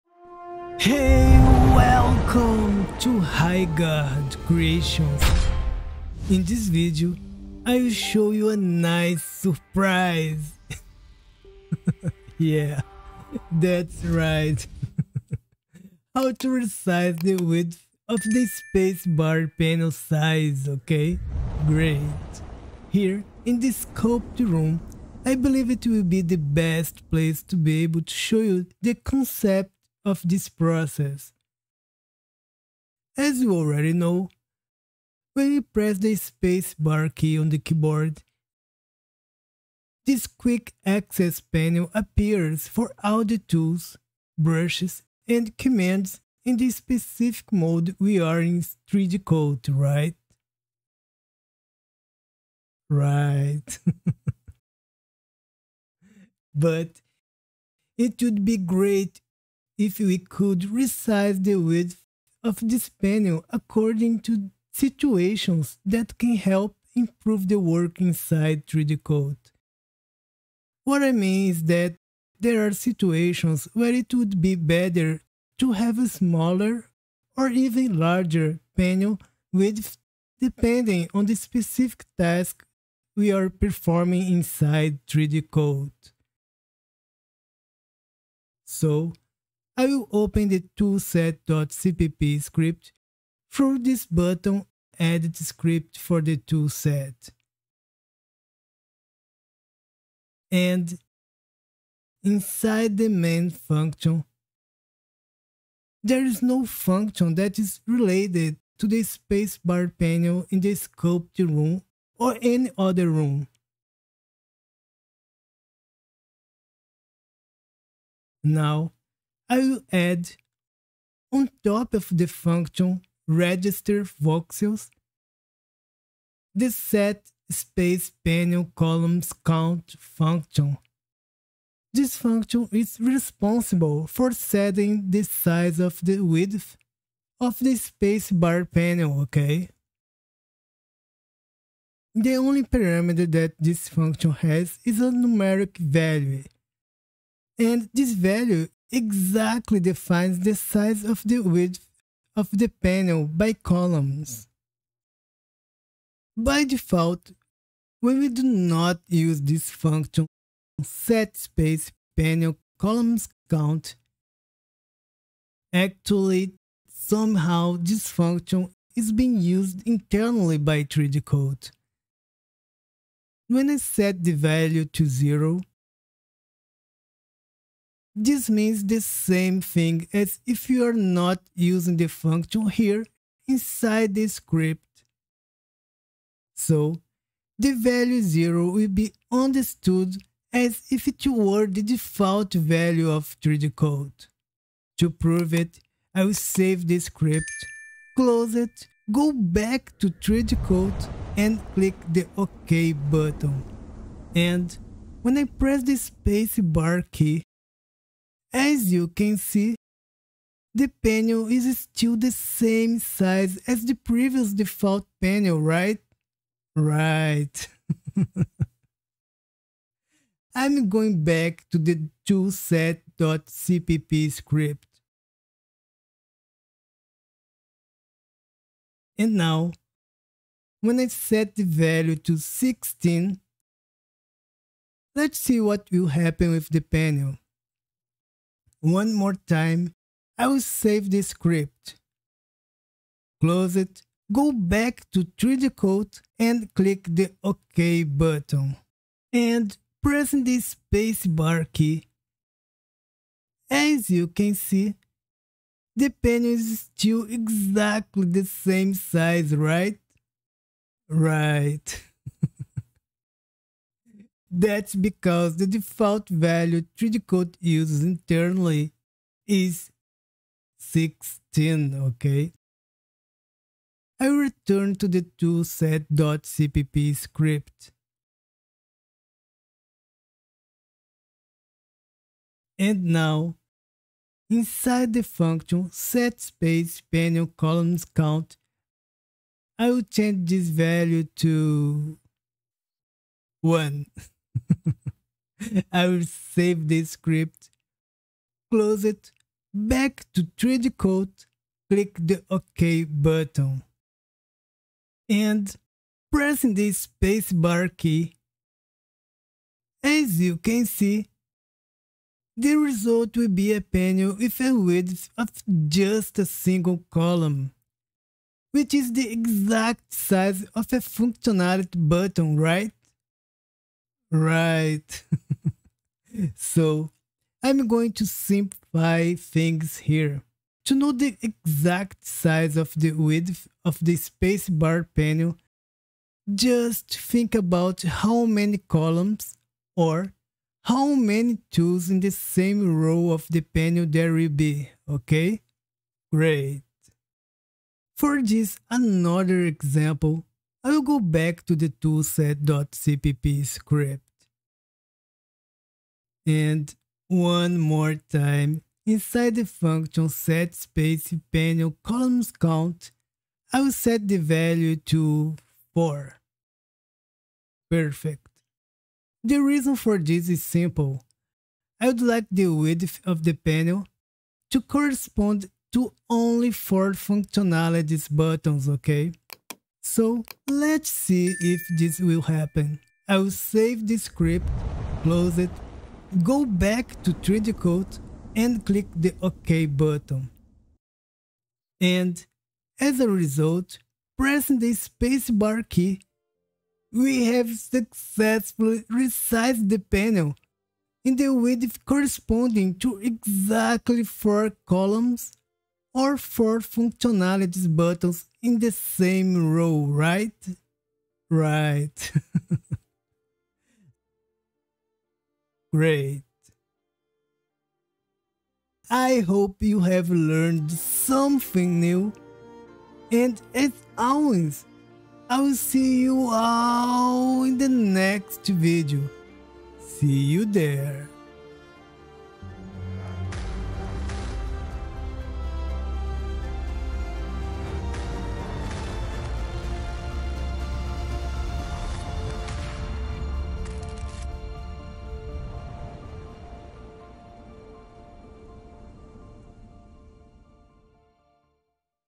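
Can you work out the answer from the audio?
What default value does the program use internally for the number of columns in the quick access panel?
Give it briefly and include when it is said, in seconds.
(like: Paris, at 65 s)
16, at 265 s.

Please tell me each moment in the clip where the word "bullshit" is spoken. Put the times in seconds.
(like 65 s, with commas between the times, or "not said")
not said.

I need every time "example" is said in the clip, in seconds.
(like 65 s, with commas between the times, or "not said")
349 s.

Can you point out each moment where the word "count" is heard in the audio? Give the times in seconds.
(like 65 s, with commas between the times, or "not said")
129 s, 163 s, 288 s, 362 s.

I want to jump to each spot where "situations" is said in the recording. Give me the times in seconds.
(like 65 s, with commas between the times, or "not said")
64 s, 72 s.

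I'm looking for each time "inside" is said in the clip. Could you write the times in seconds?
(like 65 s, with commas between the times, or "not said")
68 s, 84 s, 102 s, 183 s, 284 s, 359 s.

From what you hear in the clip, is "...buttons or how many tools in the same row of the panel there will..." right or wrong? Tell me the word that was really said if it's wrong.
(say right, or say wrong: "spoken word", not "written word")
wrong: "columns", not "buttons".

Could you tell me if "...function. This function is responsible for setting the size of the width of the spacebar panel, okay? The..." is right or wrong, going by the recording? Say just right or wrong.
right.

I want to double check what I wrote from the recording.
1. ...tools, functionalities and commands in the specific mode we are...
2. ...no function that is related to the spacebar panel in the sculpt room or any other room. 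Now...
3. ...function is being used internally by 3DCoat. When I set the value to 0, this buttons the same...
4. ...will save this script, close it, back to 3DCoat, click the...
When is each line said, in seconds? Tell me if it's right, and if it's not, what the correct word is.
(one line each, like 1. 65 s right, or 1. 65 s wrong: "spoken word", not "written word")
1. 43 s wrong: "brushes", not "functionalities"
2. 106 s right
3. 168 s wrong: "means", not "buttons"
4. 296 s right.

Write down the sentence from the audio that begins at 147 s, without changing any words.
And this value exactly defines the size of the width of the panel by columns.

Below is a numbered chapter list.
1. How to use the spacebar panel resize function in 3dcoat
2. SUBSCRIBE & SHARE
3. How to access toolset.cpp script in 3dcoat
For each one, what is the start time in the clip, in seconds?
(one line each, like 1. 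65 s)
1. 117 s
2. 418 s
3. 87 s.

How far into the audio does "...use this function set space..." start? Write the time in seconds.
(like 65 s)
159 s.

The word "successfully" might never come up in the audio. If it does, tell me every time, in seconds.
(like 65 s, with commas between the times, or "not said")
397 s.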